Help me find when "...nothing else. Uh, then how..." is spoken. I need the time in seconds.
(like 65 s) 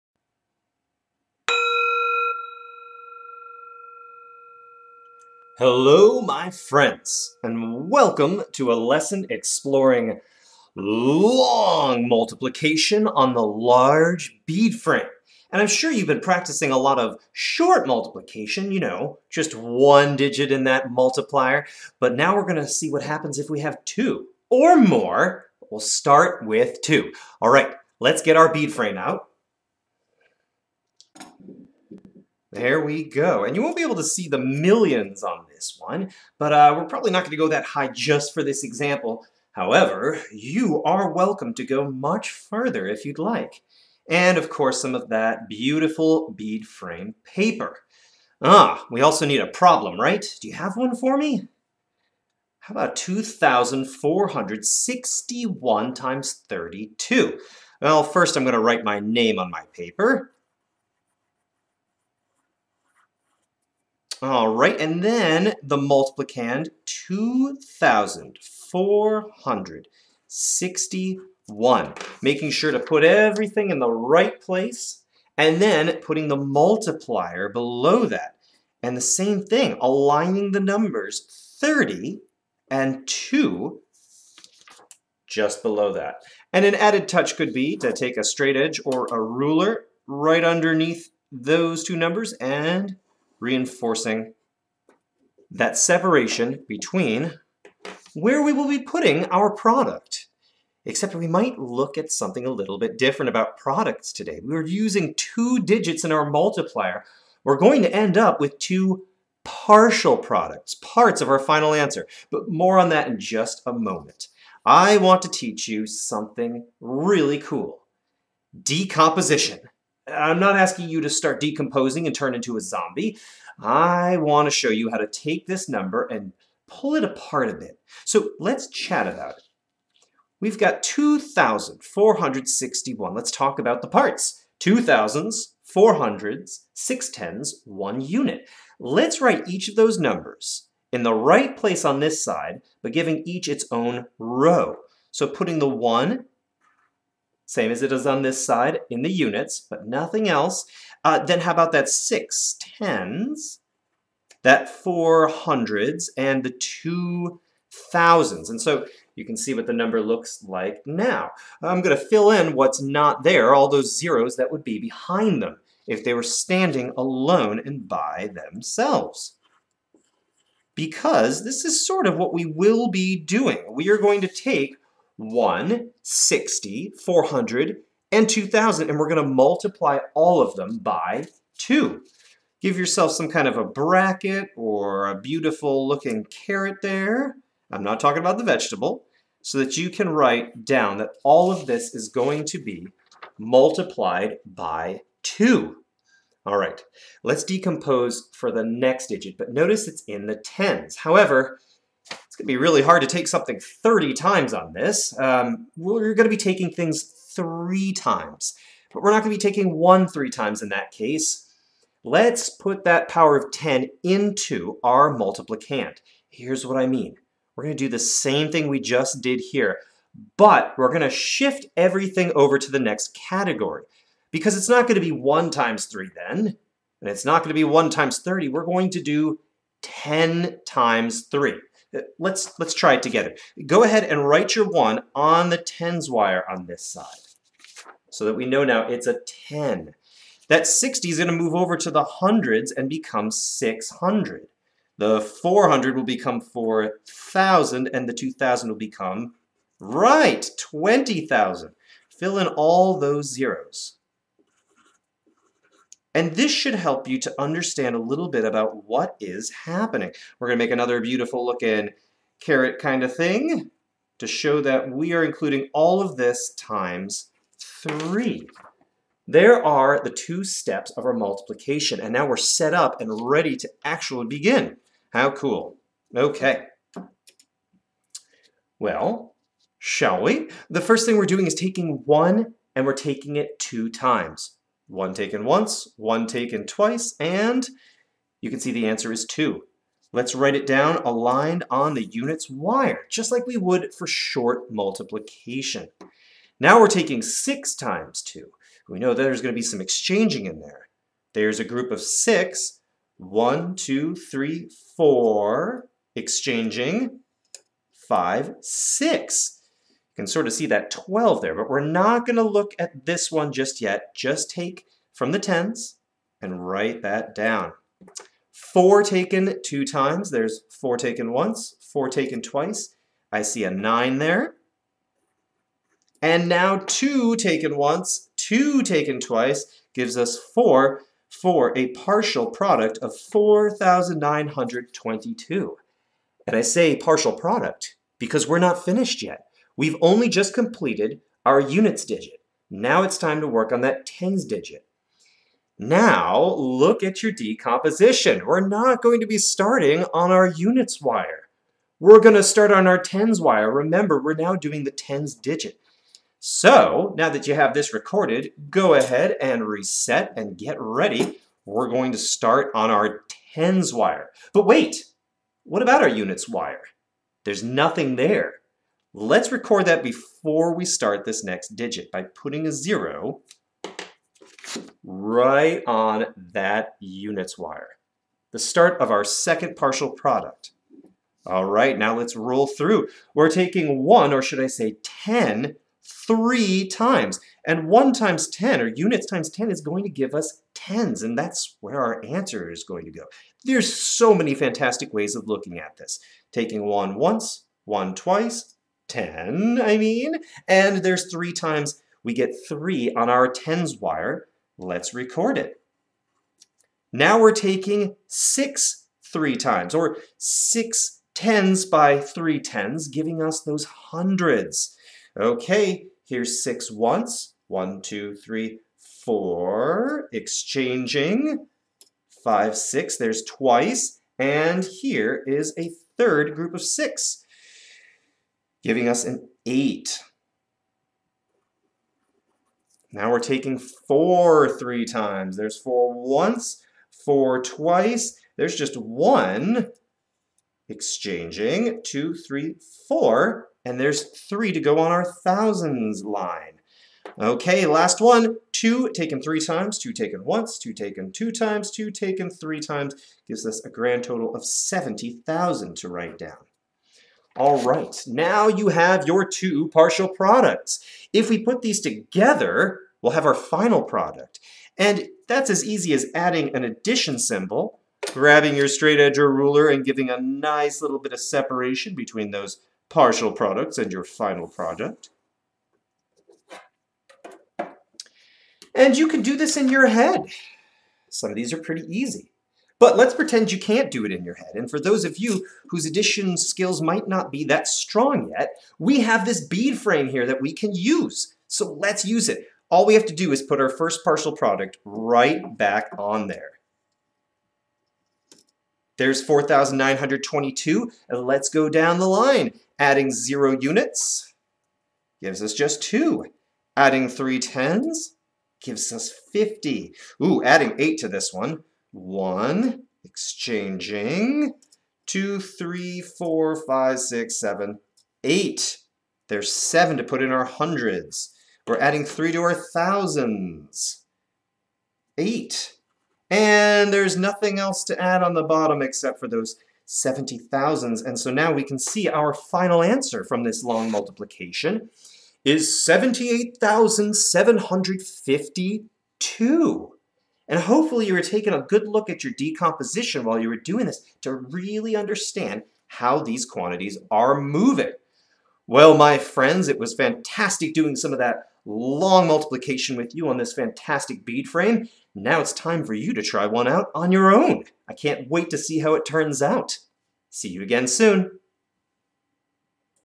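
149 s.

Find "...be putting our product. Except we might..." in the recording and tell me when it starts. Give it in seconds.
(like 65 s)
98 s.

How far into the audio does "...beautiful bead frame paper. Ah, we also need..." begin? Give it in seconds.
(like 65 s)
45 s.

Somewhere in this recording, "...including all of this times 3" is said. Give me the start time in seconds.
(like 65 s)
265 s.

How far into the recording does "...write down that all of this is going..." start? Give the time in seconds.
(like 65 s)
190 s.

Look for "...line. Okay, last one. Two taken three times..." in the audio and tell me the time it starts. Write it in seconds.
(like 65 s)
446 s.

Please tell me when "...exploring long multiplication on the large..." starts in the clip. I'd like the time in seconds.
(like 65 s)
9 s.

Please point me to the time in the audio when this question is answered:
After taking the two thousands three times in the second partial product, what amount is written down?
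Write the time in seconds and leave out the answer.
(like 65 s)
454 s.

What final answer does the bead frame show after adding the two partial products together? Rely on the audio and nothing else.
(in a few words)
78,752.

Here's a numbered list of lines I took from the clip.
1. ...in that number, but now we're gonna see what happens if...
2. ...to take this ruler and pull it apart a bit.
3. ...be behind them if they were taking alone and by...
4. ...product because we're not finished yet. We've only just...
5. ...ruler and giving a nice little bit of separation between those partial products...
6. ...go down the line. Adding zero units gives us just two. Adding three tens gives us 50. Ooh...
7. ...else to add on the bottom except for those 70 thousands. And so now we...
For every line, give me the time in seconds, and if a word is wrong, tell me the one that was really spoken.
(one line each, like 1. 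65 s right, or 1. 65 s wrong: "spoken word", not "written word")
1. 20 s wrong: "multiplier", not "number"
2. 124 s wrong: "number", not "ruler"
3. 164 s wrong: "standing", not "taking"
4. 337 s right
5. 469 s right
6. 501 s right
7. 527 s right.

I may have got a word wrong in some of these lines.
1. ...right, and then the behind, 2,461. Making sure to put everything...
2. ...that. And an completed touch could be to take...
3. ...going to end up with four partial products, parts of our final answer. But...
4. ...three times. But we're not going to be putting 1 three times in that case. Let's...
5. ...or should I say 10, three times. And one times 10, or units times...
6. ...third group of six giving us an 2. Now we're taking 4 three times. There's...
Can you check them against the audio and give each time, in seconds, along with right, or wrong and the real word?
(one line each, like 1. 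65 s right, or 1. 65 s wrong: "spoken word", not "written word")
1. 64 s wrong: "multiplicand", not "behind"
2. 85 s wrong: "added", not "completed"
3. 107 s wrong: "two", not "four"
4. 207 s wrong: "taking", not "putting"
5. 384 s right
6. 426 s wrong: "8", not "2".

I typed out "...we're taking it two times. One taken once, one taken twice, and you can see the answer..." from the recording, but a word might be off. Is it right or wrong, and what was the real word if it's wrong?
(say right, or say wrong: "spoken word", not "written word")
right.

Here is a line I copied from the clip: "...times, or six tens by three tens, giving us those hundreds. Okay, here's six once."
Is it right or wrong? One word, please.
right.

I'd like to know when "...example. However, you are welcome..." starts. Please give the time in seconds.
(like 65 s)
38 s.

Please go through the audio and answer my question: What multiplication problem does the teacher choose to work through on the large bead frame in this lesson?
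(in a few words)
2,461 times 32.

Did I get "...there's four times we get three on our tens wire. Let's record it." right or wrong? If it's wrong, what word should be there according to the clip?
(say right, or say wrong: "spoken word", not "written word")
wrong: "three", not "four".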